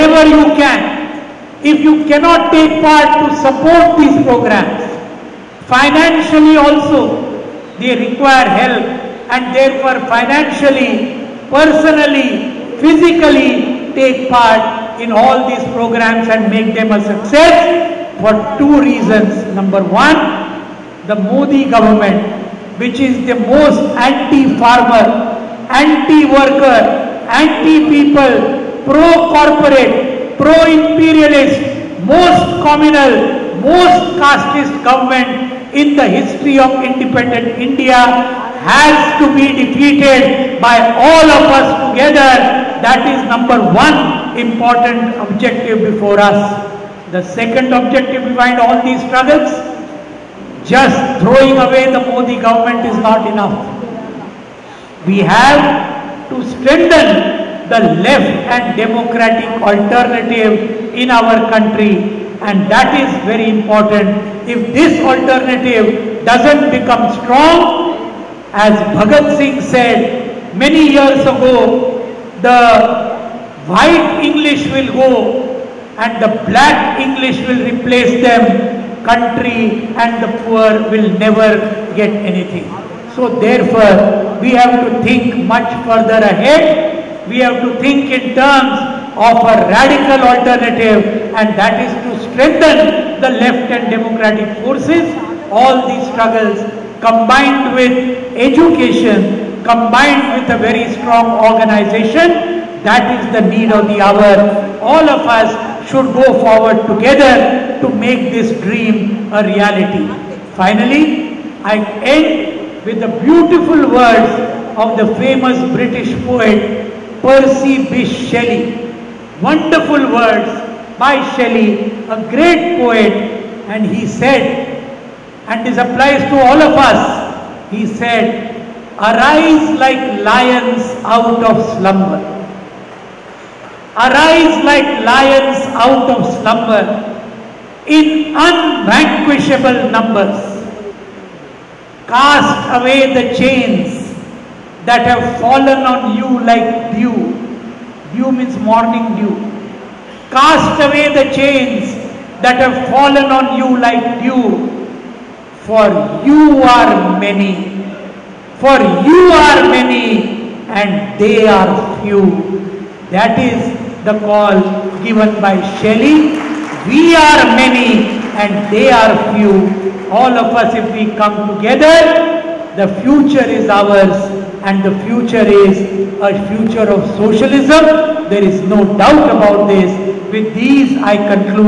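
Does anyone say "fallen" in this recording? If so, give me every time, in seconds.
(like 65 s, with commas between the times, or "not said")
145 s, 152 s.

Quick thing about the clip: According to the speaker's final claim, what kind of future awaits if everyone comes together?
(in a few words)
socialism.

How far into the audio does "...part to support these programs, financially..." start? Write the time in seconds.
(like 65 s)
2 s.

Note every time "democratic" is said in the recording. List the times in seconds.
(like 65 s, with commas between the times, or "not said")
58 s, 93 s.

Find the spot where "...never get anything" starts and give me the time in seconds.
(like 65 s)
81 s.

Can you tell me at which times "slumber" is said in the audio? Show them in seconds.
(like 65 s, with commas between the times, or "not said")
131 s, 136 s.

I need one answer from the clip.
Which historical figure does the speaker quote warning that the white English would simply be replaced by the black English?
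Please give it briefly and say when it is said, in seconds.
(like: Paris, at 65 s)
Bhagat Singh, at 68 s.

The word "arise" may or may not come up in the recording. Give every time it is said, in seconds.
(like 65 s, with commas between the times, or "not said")
129 s, 133 s.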